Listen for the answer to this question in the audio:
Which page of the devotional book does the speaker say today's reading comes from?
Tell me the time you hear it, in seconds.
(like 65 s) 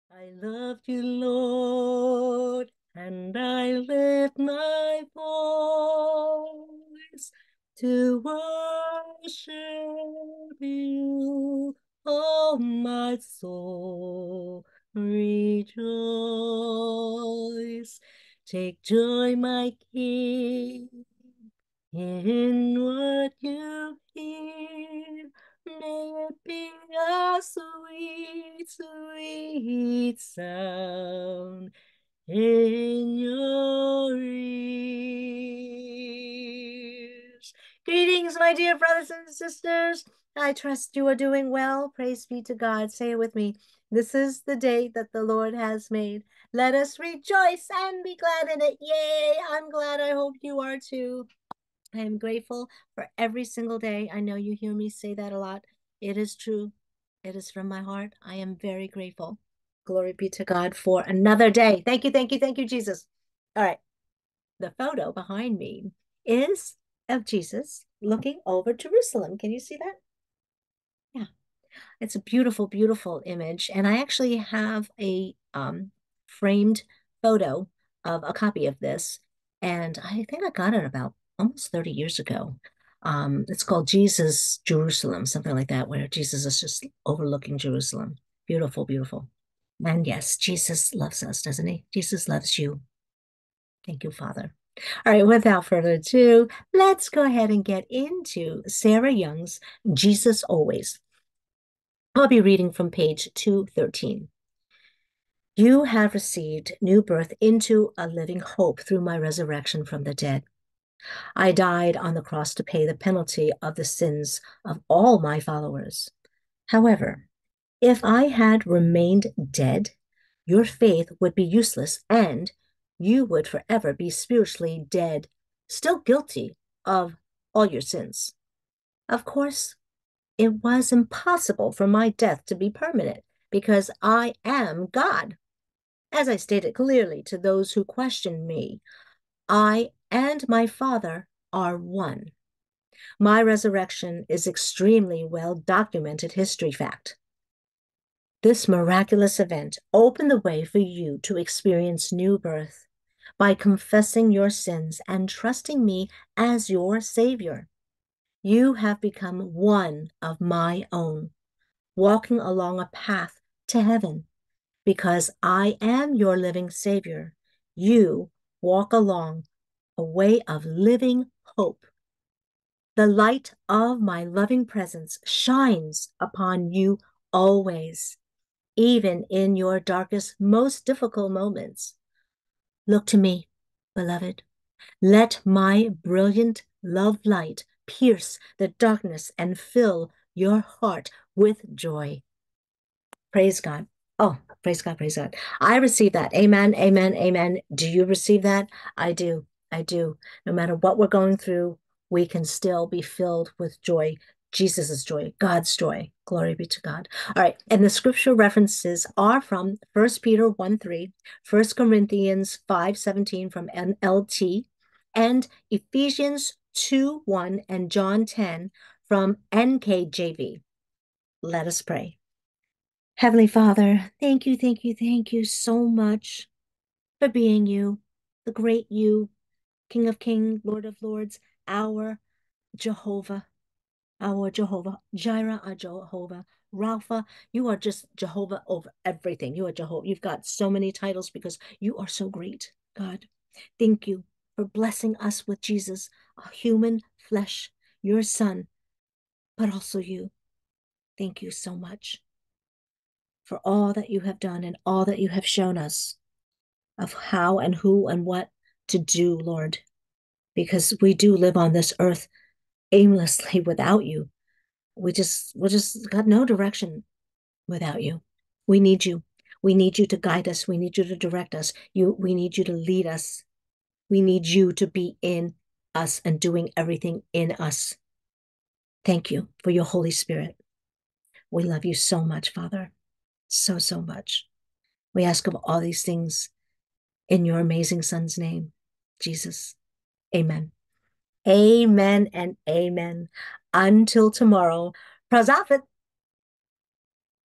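103 s.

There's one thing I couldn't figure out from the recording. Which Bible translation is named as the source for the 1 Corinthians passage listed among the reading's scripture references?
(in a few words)
NLT.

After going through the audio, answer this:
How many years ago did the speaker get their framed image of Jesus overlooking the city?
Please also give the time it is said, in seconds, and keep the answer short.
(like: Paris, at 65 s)
30, at 81 s.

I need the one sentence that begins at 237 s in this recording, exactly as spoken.
You are just Jehovah over everything.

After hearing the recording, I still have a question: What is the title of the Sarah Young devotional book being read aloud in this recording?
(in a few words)
Jesus Always.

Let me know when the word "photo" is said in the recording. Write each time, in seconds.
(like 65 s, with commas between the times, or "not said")
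64 s, 77 s.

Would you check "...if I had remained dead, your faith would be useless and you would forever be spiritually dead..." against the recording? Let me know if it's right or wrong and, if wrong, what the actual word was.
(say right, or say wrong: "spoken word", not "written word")
right.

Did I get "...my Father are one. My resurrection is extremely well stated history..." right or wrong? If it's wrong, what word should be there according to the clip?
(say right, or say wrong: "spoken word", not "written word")
wrong: "documented", not "stated".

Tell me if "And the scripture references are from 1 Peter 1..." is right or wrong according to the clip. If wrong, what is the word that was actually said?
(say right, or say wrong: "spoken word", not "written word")
right.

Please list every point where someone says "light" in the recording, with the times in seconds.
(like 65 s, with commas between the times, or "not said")
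173 s, 187 s.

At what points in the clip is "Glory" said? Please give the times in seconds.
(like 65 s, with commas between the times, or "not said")
59 s, 206 s.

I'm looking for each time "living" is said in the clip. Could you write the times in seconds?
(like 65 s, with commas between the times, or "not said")
108 s, 166 s, 170 s.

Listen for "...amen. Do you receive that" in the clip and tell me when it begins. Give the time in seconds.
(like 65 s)
197 s.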